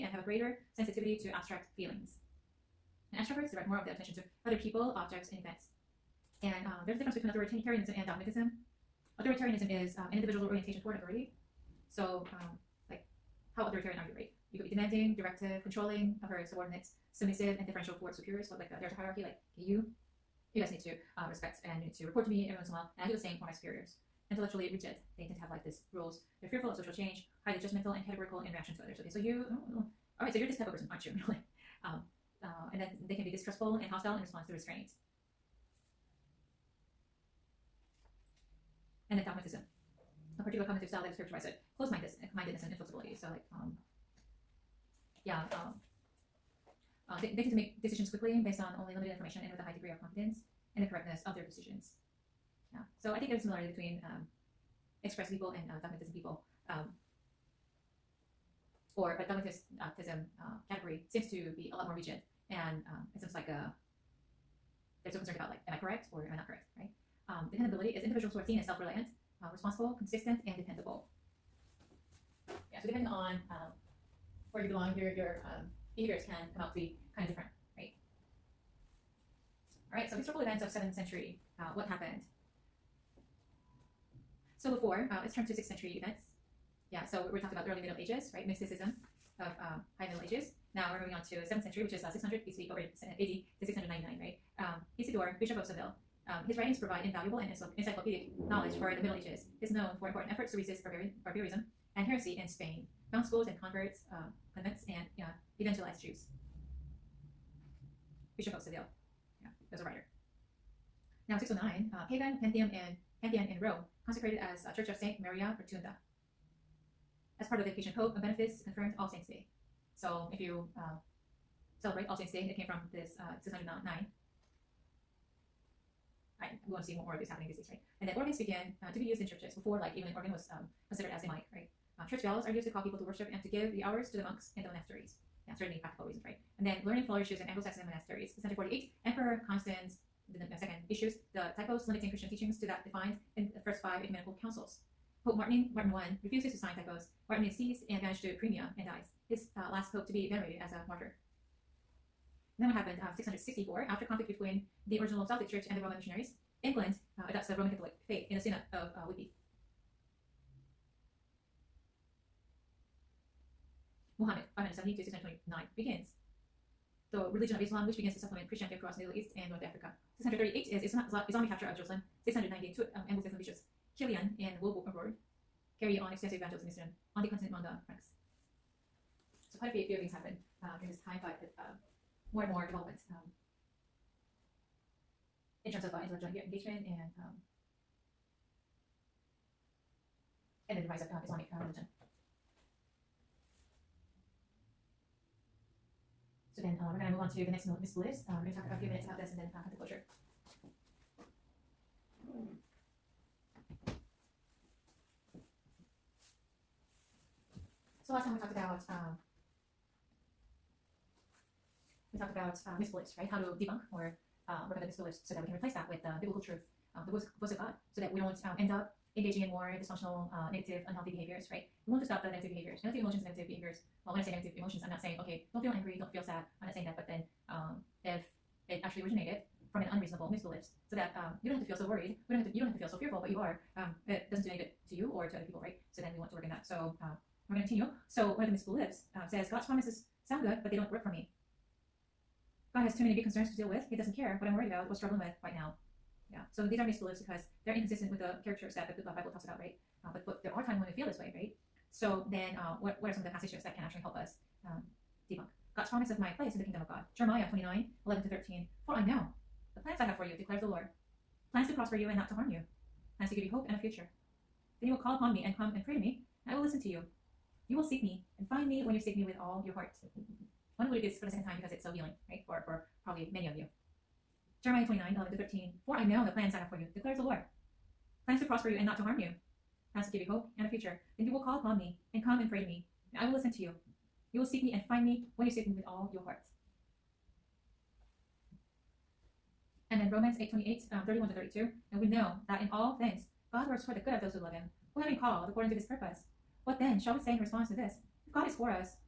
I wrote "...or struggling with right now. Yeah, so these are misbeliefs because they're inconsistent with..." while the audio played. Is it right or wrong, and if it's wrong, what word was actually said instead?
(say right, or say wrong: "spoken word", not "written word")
right.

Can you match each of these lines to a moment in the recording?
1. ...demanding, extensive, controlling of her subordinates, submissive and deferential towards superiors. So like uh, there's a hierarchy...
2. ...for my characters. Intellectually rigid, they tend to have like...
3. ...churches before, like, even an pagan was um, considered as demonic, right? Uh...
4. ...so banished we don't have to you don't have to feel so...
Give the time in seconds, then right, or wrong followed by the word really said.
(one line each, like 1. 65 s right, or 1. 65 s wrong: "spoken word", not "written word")
1. 14 s wrong: "directive", not "extensive"
2. 23 s wrong: "superiors", not "characters"
3. 129 s wrong: "organ", not "pagan"
4. 231 s wrong: "worried", not "banished".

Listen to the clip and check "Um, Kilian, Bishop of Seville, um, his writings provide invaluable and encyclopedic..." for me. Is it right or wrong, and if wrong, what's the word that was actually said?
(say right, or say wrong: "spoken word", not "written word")
wrong: "Isidore", not "Kilian".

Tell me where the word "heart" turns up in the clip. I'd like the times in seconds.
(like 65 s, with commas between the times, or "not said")
269 s, 286 s.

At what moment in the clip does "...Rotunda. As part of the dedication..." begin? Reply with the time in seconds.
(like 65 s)
115 s.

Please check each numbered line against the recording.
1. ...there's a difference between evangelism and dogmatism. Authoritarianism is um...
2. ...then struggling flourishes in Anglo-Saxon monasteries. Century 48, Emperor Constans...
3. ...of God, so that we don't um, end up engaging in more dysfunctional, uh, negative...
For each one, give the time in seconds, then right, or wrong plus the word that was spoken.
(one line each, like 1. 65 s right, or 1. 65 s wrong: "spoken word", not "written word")
1. 6 s wrong: "authoritarianism", not "evangelism"
2. 136 s wrong: "learning", not "struggling"
3. 217 s right.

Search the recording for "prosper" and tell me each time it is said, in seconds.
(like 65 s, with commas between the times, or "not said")
261 s, 278 s.